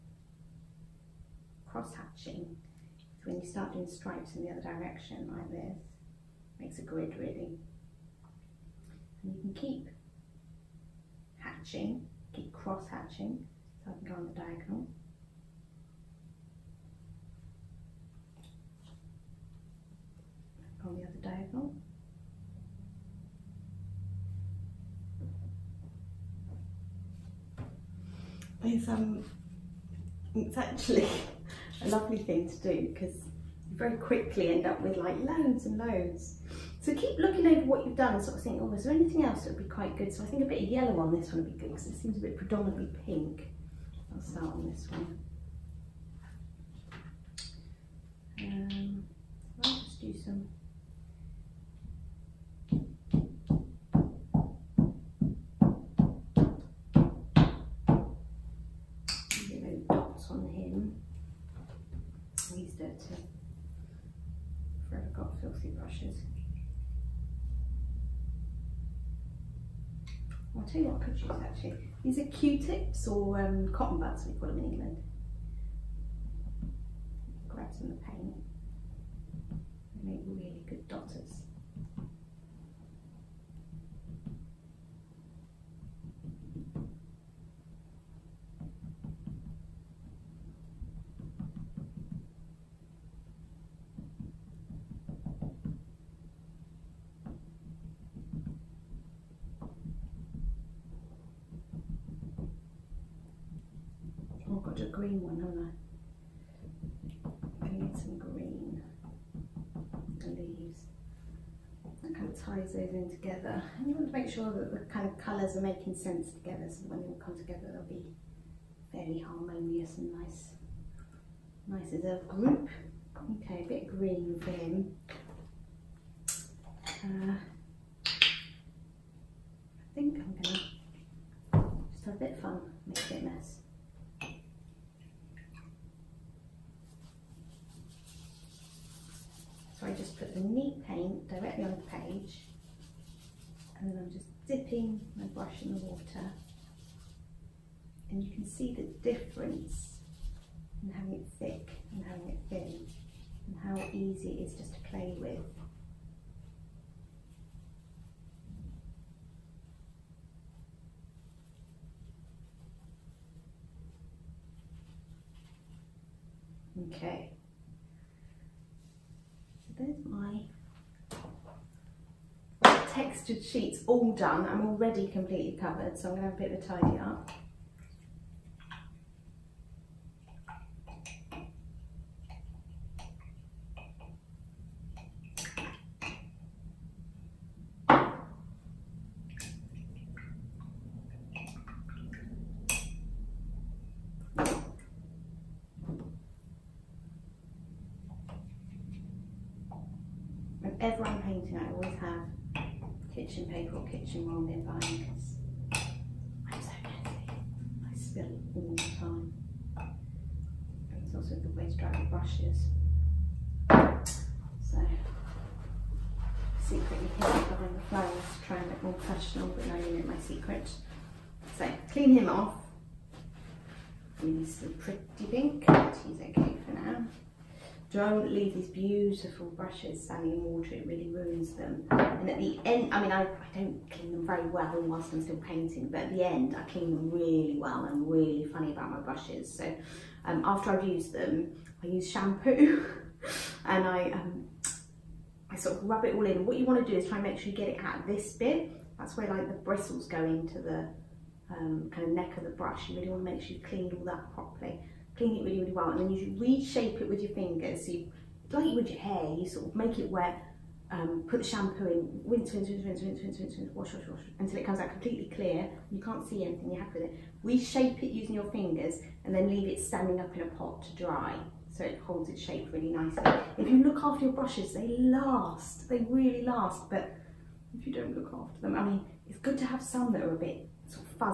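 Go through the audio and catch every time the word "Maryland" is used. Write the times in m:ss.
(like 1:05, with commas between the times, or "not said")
not said.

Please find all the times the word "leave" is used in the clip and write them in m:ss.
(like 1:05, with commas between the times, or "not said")
3:48, 4:29.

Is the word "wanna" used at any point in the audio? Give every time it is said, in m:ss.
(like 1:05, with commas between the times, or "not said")
4:06, 4:13.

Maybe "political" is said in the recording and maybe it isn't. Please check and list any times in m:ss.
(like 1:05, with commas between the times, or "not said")
not said.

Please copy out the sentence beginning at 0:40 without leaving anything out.
So I think a bit of yellow on this one would be good because it seems a bit predominantly pink.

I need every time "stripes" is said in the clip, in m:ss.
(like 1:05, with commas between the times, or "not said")
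0:03.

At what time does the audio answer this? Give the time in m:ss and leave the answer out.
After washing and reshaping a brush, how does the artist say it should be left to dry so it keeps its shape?
4:29.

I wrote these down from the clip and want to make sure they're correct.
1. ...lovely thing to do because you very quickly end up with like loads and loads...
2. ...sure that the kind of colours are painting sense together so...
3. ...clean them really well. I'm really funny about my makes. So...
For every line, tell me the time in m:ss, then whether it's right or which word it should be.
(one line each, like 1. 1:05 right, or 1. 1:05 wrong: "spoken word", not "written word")
1. 0:31 right
2. 1:54 wrong: "making", not "painting"
3. 3:56 wrong: "brushes", not "makes".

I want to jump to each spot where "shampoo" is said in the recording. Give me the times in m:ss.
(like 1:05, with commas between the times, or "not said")
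4:02, 4:21.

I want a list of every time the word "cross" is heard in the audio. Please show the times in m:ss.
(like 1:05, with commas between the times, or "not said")
0:01, 0:12.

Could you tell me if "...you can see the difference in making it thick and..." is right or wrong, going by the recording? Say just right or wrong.
wrong.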